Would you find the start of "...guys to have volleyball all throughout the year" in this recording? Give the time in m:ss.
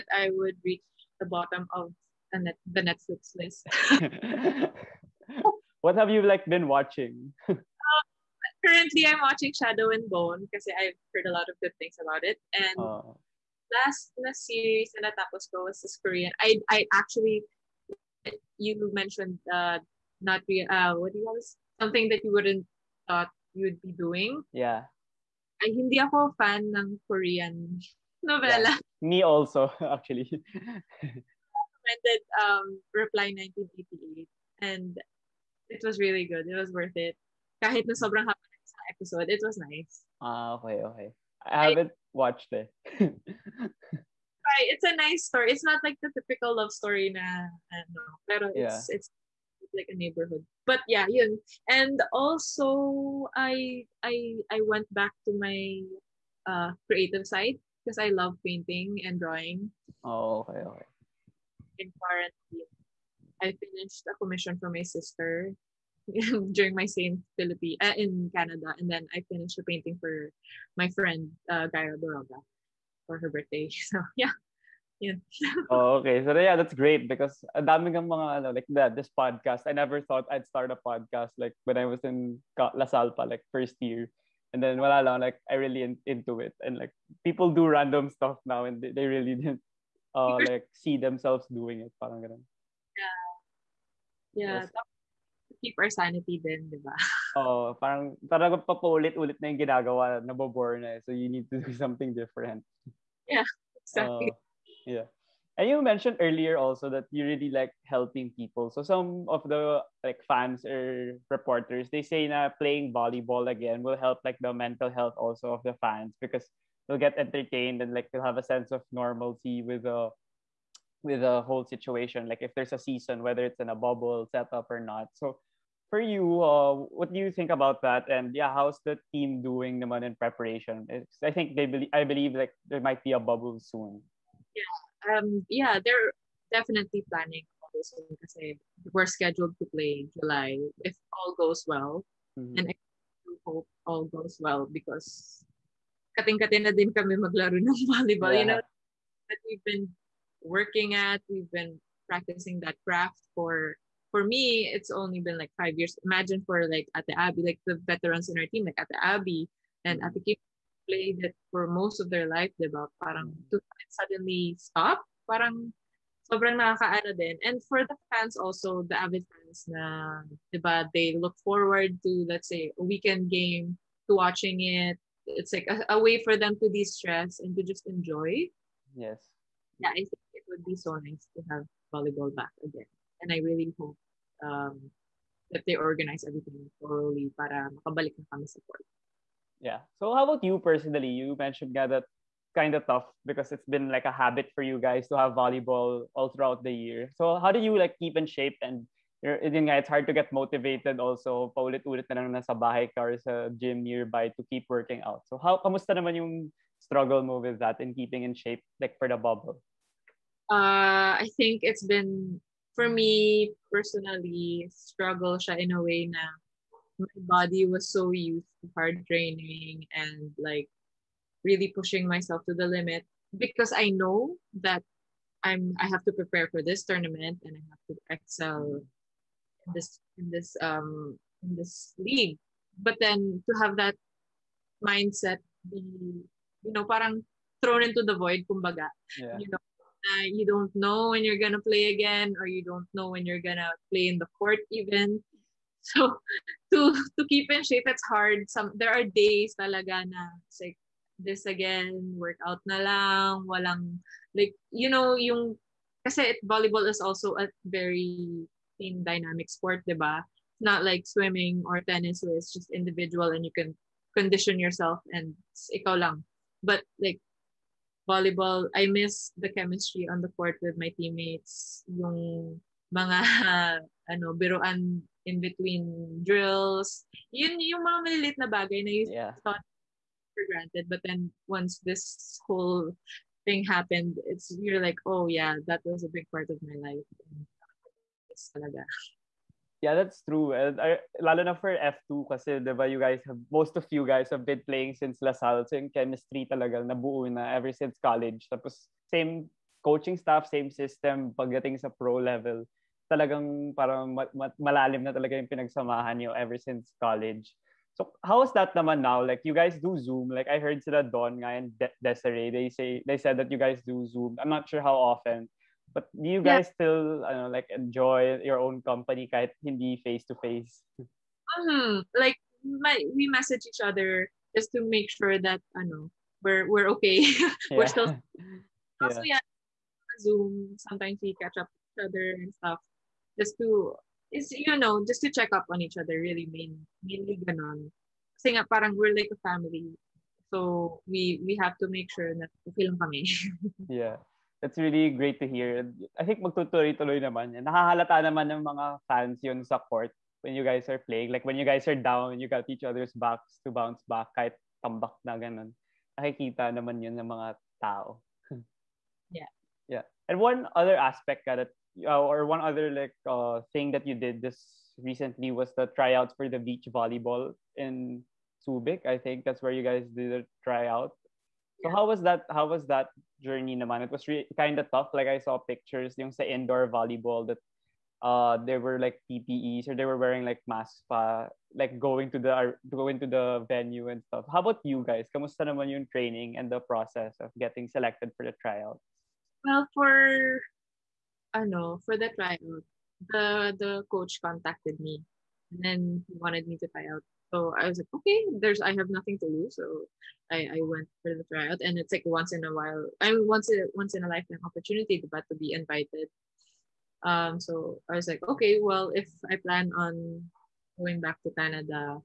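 3:14.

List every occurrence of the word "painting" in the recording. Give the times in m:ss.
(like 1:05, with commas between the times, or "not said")
0:58, 1:09.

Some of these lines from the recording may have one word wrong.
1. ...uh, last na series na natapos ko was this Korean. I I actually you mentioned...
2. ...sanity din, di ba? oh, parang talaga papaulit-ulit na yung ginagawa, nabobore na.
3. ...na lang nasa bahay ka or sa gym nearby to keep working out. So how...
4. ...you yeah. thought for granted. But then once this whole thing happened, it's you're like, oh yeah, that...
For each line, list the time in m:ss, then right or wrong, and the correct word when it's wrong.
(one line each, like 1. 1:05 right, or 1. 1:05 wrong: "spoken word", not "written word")
1. 0:12 right
2. 1:35 right
3. 3:22 right
4. 4:38 right.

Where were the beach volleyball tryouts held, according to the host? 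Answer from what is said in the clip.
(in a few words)
Subic.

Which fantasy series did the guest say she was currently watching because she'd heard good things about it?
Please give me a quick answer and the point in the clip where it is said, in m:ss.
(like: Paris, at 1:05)
Shadow and Bone, at 0:09.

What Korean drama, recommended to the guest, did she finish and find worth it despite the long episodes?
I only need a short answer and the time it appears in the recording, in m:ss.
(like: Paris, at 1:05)
Reply 1988, at 0:32.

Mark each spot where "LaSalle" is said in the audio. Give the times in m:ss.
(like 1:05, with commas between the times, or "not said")
1:22, 4:55.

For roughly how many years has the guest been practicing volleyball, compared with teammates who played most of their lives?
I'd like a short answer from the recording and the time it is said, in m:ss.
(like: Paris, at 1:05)
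5 years, at 2:35.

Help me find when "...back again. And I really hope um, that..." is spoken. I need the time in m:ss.
3:02.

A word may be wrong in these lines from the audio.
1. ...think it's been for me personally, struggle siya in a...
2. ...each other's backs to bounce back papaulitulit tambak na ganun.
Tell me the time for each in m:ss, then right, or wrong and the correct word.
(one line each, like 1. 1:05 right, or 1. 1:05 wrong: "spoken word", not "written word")
1. 3:31 right
2. 5:52 wrong: "kahit", not "papaulitulit".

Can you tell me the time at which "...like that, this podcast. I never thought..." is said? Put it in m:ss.
1:18.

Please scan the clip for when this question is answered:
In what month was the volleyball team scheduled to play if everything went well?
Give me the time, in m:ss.
2:20.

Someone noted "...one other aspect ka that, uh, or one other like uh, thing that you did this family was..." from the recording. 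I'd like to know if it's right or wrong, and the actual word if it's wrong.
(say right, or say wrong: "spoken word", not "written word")
wrong: "recently", not "family".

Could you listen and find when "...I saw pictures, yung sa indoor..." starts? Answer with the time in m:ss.
6:15.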